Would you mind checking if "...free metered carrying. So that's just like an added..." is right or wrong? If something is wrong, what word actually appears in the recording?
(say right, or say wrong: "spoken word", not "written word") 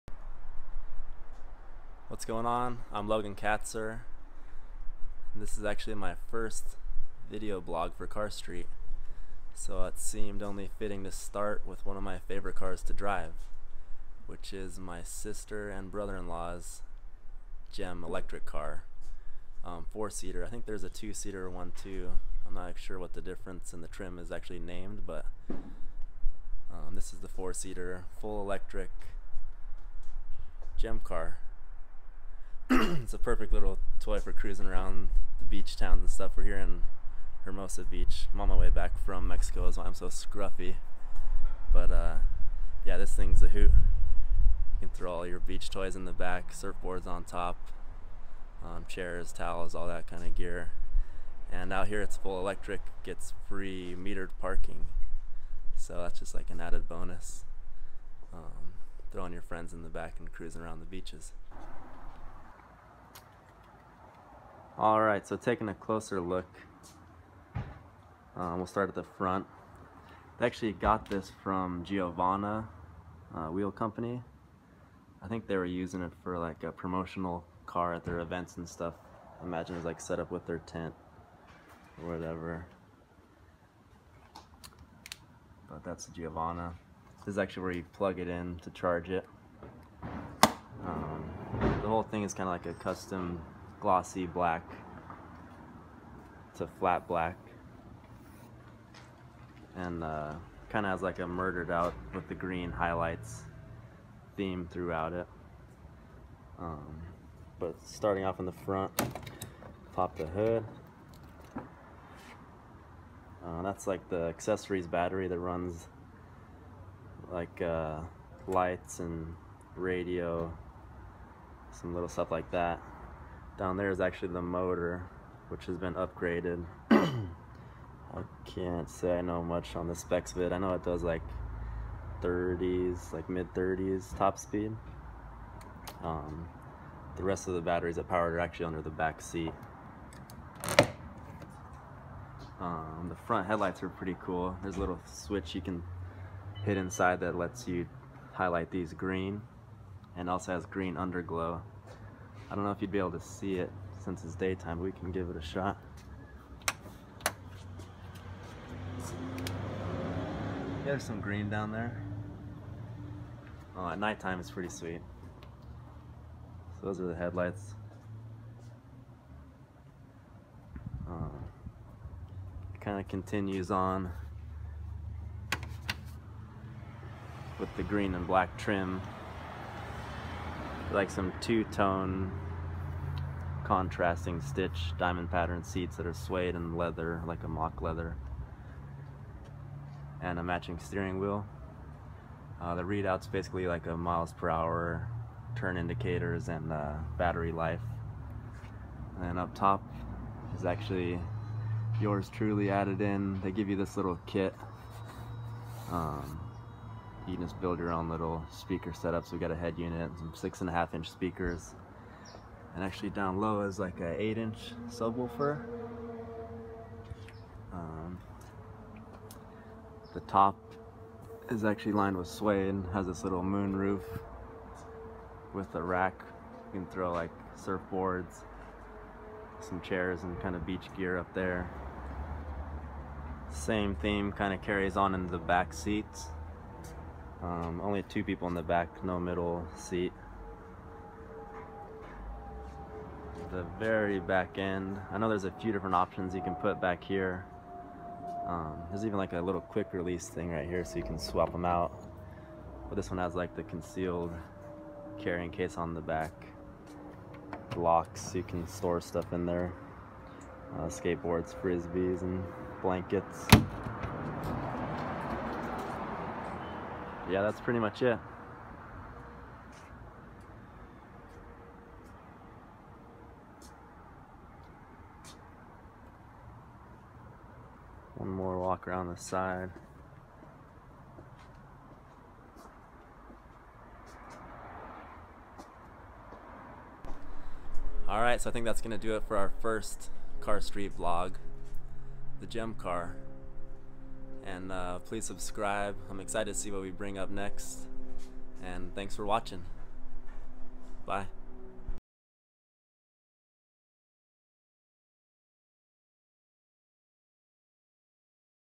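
wrong: "parking", not "carrying".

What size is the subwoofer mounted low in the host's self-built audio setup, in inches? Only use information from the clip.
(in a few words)
8 inch.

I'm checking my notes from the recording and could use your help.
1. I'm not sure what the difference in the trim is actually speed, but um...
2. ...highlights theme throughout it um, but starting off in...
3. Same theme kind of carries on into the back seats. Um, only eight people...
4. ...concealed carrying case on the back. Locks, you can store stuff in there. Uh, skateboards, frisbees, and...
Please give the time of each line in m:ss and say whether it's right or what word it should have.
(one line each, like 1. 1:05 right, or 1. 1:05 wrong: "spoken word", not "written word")
1. 0:22 wrong: "named", not "speed"
2. 1:42 right
3. 3:53 wrong: "two", not "eight"
4. 4:13 right.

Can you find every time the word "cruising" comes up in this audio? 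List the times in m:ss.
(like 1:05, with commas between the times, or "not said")
0:34, 1:00.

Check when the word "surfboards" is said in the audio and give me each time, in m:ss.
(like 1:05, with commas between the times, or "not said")
0:46, 3:47.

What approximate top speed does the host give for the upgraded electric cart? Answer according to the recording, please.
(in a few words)
mid 30s.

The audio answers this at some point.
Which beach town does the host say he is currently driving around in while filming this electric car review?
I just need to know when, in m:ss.
0:37.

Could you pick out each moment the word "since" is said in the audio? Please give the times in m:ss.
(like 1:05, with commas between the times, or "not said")
2:34.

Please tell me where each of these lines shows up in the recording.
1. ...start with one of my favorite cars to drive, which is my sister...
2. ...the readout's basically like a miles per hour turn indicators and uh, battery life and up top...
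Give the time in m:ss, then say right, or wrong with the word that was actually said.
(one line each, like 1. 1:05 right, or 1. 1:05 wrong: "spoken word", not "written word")
1. 0:11 right
2. 3:12 right.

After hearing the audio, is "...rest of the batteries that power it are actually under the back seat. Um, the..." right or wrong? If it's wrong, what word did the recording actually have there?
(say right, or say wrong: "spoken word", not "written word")
right.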